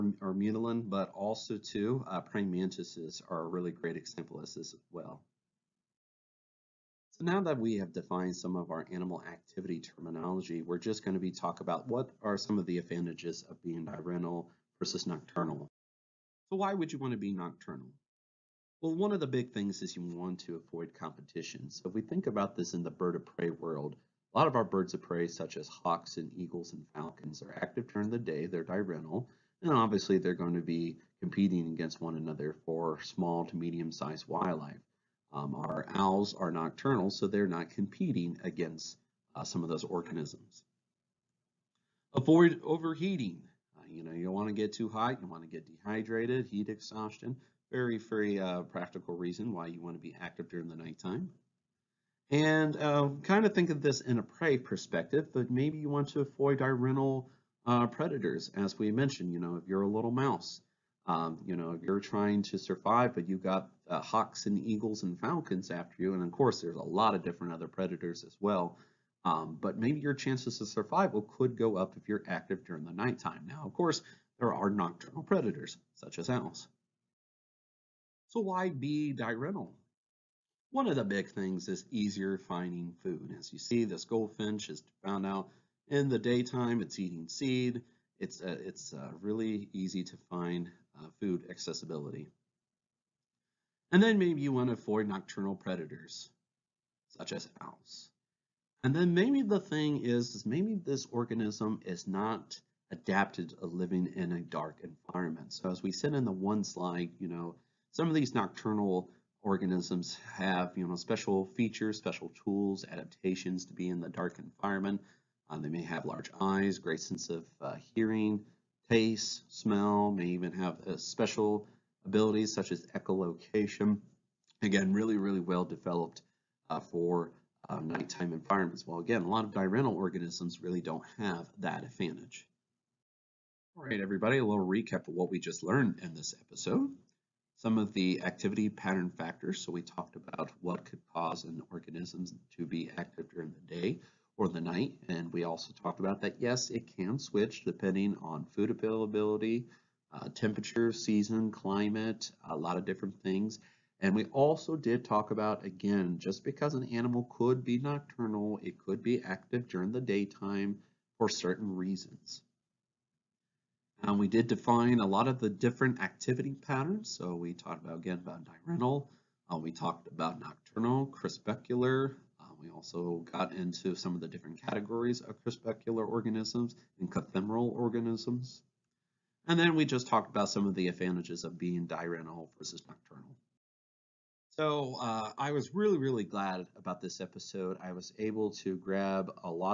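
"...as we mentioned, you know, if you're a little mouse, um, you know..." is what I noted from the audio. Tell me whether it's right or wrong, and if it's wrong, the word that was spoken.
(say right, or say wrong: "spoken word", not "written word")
right.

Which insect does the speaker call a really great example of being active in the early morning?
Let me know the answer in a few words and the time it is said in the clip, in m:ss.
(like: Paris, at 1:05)
Praying mantises, at 0:02.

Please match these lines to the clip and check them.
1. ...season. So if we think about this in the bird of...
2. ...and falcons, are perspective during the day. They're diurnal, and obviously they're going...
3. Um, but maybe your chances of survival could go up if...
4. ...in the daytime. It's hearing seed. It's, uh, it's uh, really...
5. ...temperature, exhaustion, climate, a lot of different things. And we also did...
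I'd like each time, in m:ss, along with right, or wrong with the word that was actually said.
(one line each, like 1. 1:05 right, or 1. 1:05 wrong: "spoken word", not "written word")
1. 0:20 wrong: "competition", not "season"
2. 0:26 wrong: "active", not "perspective"
3. 1:09 right
4. 1:25 wrong: "eating", not "hearing"
5. 2:30 wrong: "season", not "exhaustion".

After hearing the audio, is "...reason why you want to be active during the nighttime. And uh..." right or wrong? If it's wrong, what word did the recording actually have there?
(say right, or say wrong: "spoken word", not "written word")
right.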